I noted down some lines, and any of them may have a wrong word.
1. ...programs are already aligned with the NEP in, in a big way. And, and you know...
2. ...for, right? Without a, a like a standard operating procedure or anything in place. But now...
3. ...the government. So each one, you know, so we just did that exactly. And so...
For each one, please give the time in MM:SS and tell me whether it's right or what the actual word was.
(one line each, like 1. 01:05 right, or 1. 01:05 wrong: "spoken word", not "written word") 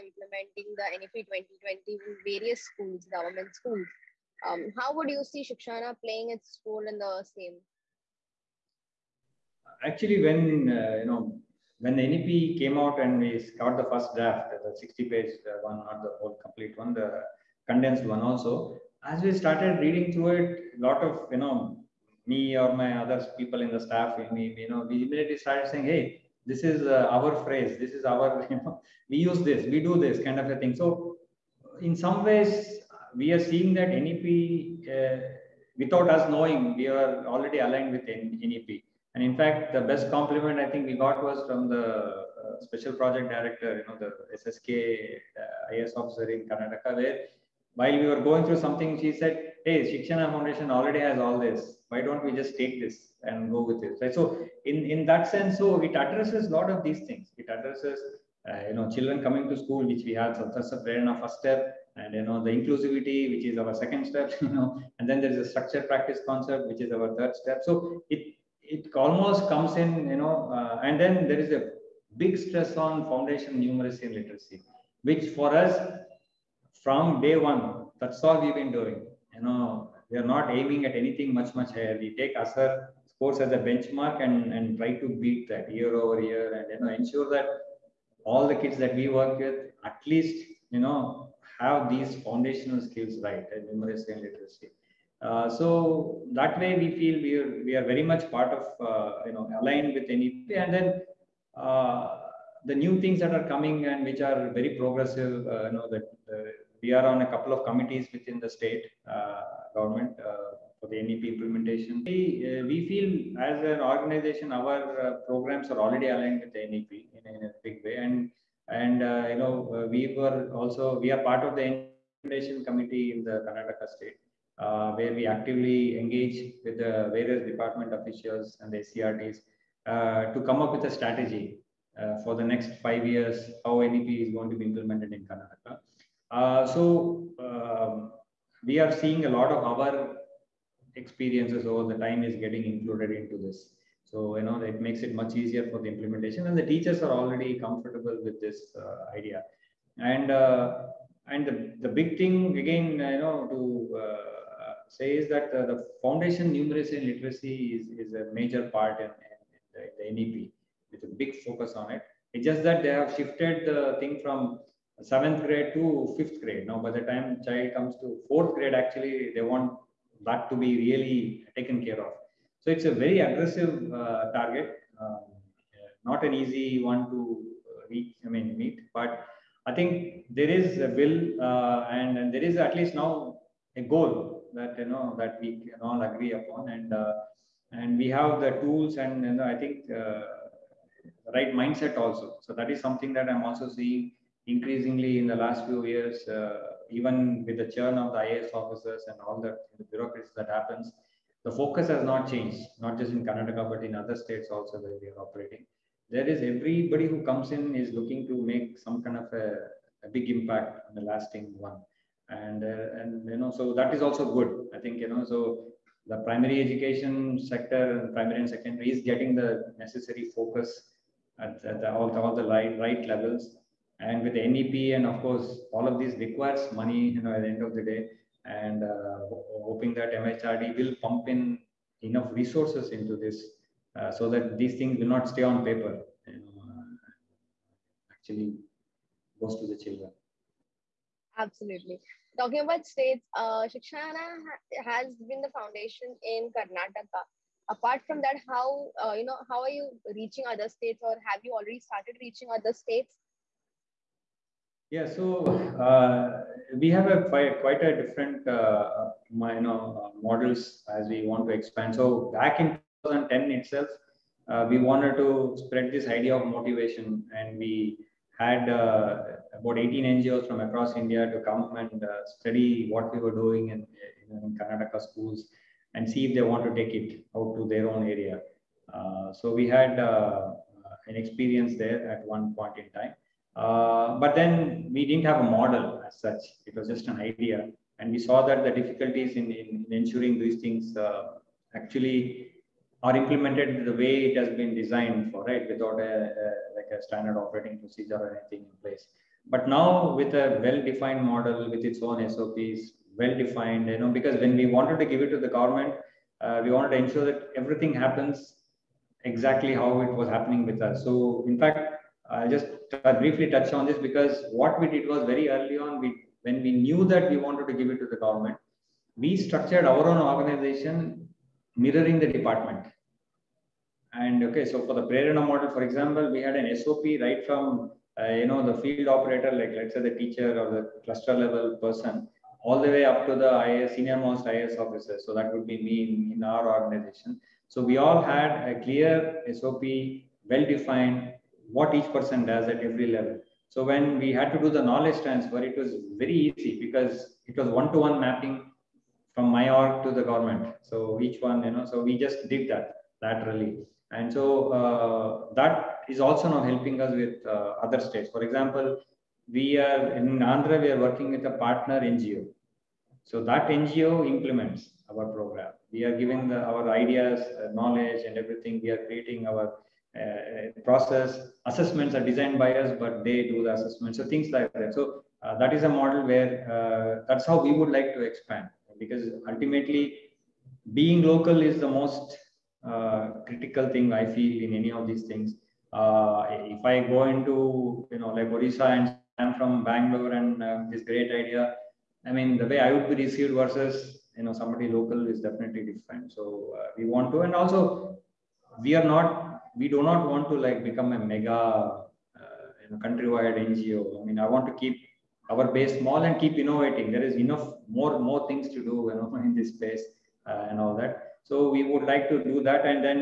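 1. 01:55 right
2. 04:55 right
3. 05:50 wrong: "laterally", not "exactly".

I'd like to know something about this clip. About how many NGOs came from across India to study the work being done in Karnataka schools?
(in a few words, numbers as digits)
18.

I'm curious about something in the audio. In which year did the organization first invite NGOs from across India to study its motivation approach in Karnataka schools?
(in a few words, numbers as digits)
2010.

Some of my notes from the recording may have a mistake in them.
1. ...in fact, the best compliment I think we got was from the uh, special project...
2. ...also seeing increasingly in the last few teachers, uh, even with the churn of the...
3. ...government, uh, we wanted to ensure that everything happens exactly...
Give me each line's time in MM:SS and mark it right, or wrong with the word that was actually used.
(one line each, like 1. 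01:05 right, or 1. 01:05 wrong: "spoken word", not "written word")
1. 00:39 right
2. 03:13 wrong: "years", not "teachers"
3. 05:05 right.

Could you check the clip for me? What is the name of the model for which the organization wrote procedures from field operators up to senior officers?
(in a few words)
Prerana.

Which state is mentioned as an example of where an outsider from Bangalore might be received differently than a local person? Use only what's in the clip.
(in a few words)
Orissa.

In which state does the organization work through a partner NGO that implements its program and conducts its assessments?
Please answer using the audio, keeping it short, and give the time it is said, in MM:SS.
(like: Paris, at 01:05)
Andhra, at 06:00.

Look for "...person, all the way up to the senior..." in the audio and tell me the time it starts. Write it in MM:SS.
05:31.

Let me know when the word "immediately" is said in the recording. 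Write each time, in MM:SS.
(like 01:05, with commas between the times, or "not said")
00:25.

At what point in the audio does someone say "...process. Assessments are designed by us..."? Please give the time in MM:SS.
06:10.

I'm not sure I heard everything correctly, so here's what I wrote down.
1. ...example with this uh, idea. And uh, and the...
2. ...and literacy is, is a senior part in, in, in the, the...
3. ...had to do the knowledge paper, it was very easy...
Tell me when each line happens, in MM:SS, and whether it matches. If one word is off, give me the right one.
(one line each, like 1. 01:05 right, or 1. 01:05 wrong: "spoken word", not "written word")
1. 02:27 wrong: "comfortable", not "example"
2. 02:36 wrong: "major", not "senior"
3. 05:44 wrong: "transfer", not "paper".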